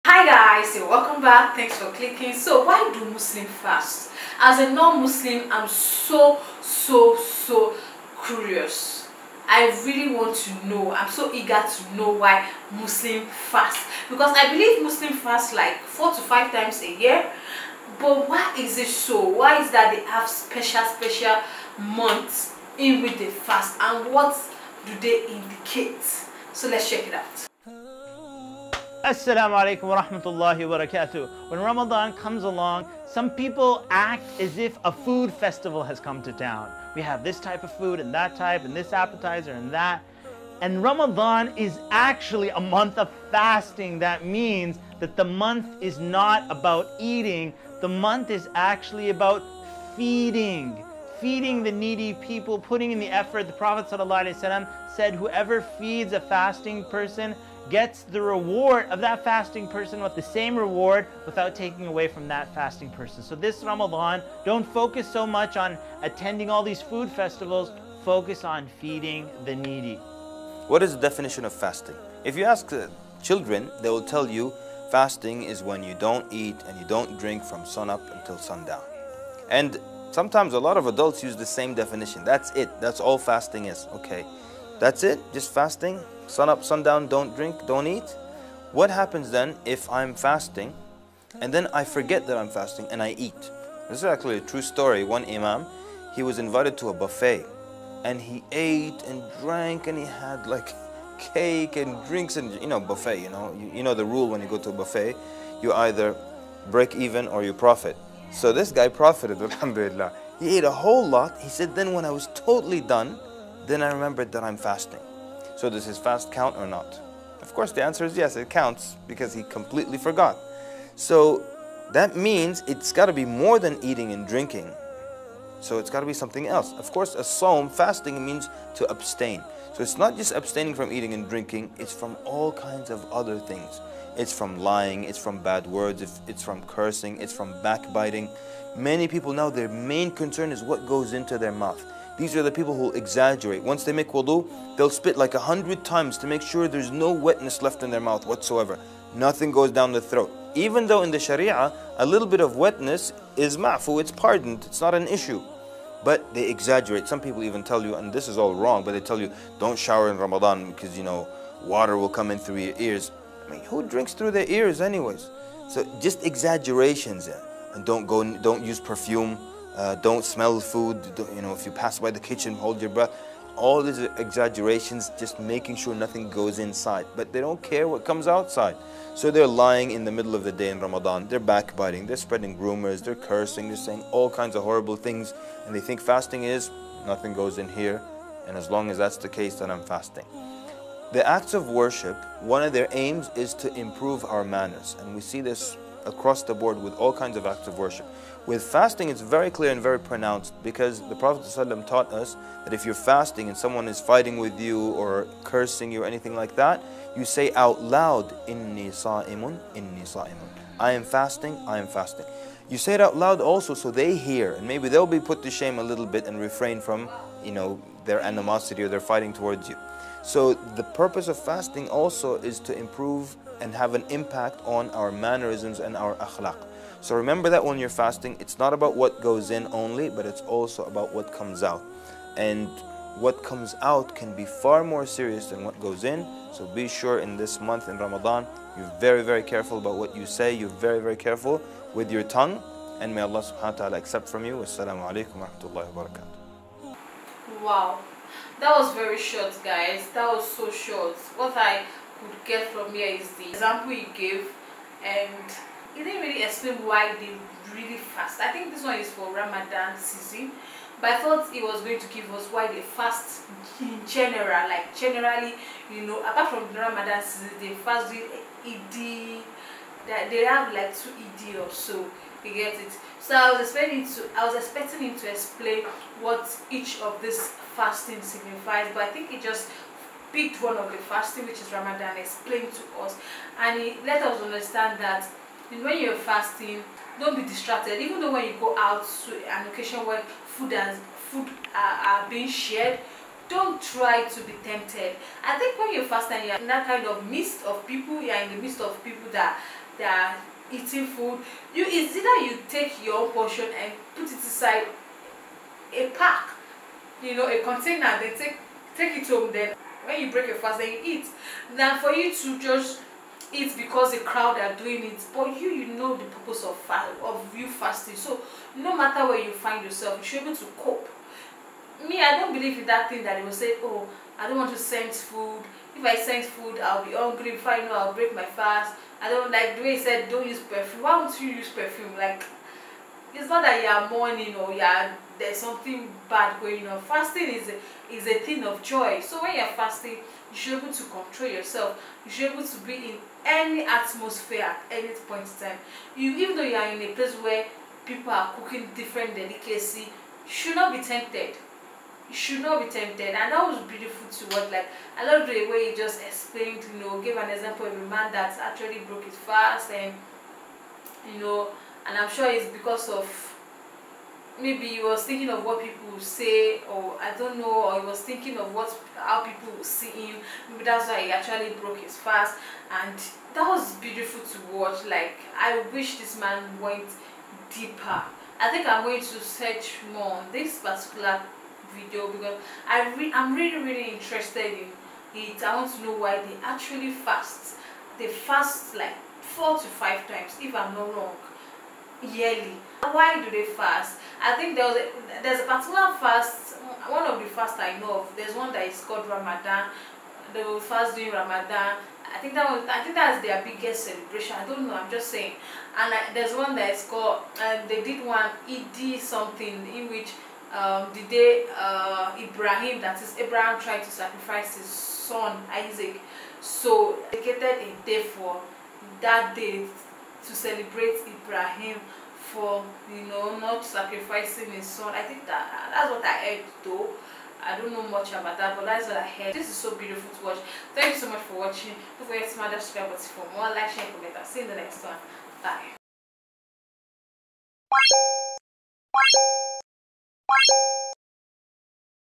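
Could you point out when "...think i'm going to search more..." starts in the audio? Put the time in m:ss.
6:18.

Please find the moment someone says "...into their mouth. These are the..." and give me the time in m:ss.
2:21.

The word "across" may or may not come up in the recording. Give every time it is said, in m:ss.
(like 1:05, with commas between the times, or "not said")
3:16.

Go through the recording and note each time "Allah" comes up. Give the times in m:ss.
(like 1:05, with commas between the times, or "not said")
4:03.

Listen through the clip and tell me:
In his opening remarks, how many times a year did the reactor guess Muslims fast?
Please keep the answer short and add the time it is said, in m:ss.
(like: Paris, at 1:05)
4 to 5, at 0:15.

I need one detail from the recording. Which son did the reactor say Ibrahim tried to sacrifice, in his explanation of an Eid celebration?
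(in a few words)
Isaac.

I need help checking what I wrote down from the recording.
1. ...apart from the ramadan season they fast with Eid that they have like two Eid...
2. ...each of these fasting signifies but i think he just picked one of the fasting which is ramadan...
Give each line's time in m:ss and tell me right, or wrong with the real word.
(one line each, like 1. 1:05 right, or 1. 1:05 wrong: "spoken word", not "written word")
1. 4:26 right
2. 4:36 right.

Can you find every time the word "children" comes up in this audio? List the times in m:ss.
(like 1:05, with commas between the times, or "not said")
1:13.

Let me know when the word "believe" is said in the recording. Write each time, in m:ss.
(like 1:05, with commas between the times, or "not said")
0:14, 5:22.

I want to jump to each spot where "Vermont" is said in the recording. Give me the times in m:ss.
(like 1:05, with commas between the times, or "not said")
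not said.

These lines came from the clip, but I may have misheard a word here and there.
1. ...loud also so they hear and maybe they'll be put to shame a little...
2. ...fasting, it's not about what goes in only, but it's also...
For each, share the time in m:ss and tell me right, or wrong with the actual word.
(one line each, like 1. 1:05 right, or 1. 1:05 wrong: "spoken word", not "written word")
1. 3:33 right
2. 3:47 right.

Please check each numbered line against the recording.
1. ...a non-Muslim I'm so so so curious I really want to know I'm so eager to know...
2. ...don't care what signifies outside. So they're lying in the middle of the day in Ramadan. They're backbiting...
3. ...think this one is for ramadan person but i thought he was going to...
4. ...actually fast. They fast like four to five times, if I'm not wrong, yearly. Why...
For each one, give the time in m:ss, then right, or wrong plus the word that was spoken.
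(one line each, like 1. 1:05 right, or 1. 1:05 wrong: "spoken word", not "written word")
1. 0:04 right
2. 2:57 wrong: "comes", not "signifies"
3. 4:18 wrong: "season", not "person"
4. 6:26 right.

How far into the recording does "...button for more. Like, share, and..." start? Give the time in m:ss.
7:13.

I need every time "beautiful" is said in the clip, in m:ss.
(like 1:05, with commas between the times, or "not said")
5:53, 6:13, 7:09.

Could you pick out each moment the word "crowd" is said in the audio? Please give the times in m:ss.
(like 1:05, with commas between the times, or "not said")
5:14.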